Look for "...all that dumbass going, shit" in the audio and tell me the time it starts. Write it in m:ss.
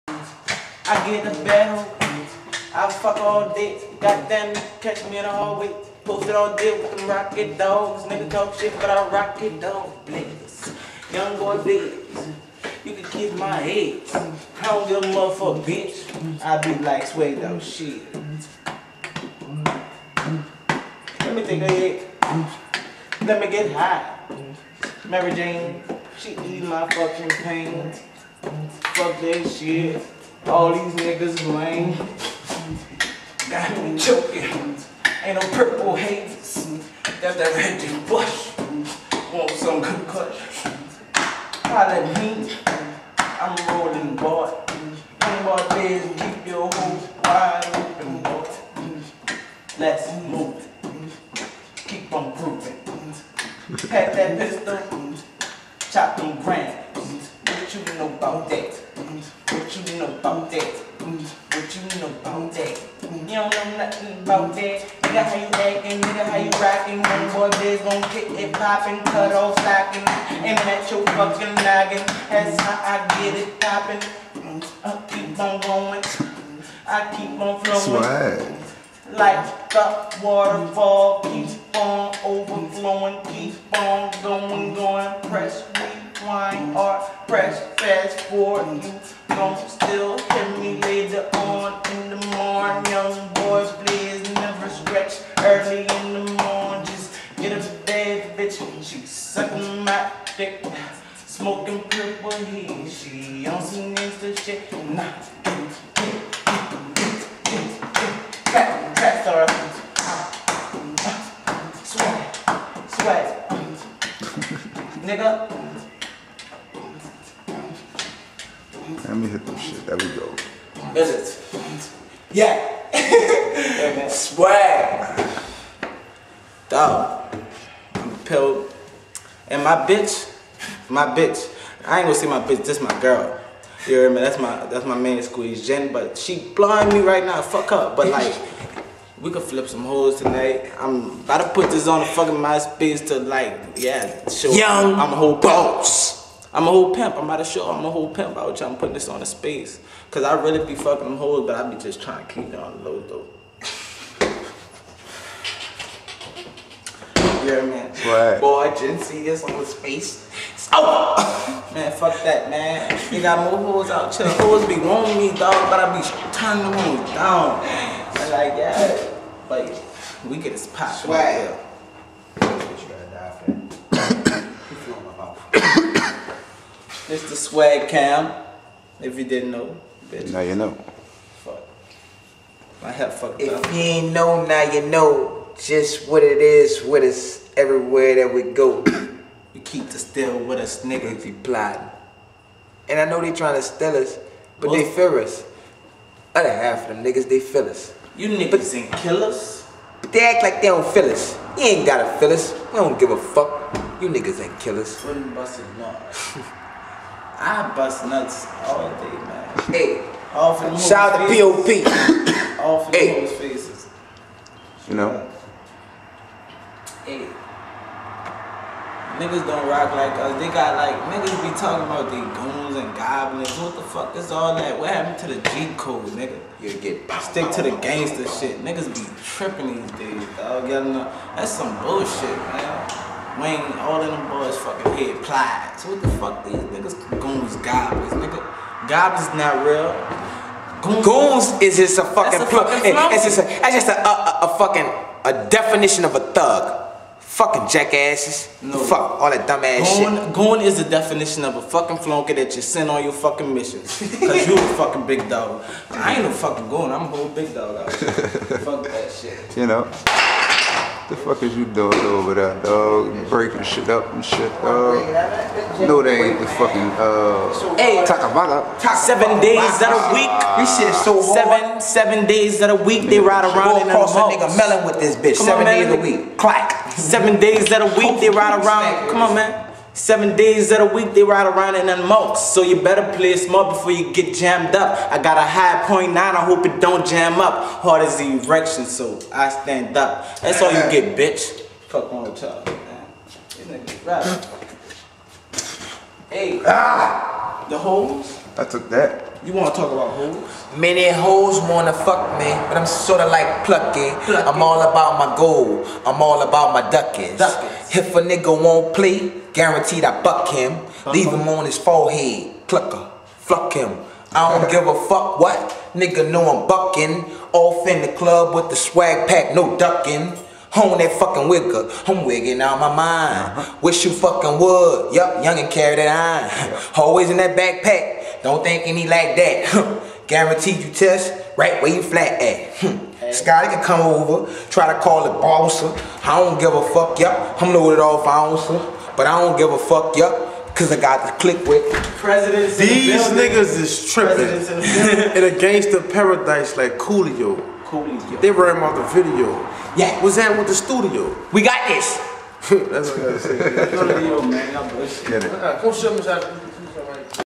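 4:09.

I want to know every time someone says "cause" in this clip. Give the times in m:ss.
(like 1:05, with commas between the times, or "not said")
2:30, 4:13, 5:40.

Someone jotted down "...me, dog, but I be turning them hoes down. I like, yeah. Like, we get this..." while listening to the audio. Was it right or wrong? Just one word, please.
right.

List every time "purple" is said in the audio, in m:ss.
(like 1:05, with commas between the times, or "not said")
0:35, 1:41.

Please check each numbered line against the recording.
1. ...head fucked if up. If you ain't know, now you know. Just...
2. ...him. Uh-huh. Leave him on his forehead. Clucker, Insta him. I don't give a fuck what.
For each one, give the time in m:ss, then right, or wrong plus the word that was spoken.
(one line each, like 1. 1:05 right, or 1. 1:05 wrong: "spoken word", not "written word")
1. 3:02 right
2. 5:10 wrong: "Fuck", not "Insta".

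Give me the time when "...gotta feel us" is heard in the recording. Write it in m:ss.
3:21.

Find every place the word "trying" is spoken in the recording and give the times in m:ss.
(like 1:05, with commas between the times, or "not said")
2:32, 3:13.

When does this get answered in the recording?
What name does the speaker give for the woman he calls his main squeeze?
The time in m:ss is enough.
2:15.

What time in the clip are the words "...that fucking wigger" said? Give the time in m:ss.
5:20.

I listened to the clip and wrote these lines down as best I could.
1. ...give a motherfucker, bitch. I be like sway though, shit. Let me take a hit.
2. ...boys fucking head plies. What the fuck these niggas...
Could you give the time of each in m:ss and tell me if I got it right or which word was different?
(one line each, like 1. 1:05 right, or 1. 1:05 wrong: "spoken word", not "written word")
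1. 0:14 right
2. 3:54 right.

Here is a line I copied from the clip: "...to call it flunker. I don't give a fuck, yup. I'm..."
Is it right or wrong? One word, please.
wrong.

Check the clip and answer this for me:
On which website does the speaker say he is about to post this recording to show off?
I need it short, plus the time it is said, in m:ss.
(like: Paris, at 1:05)
MySpace, at 2:22.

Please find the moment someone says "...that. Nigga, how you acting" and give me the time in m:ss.
1:04.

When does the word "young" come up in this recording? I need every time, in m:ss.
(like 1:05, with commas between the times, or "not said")
0:11, 2:24, 5:25.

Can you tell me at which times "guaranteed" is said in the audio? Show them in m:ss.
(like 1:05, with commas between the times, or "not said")
5:09, 5:30.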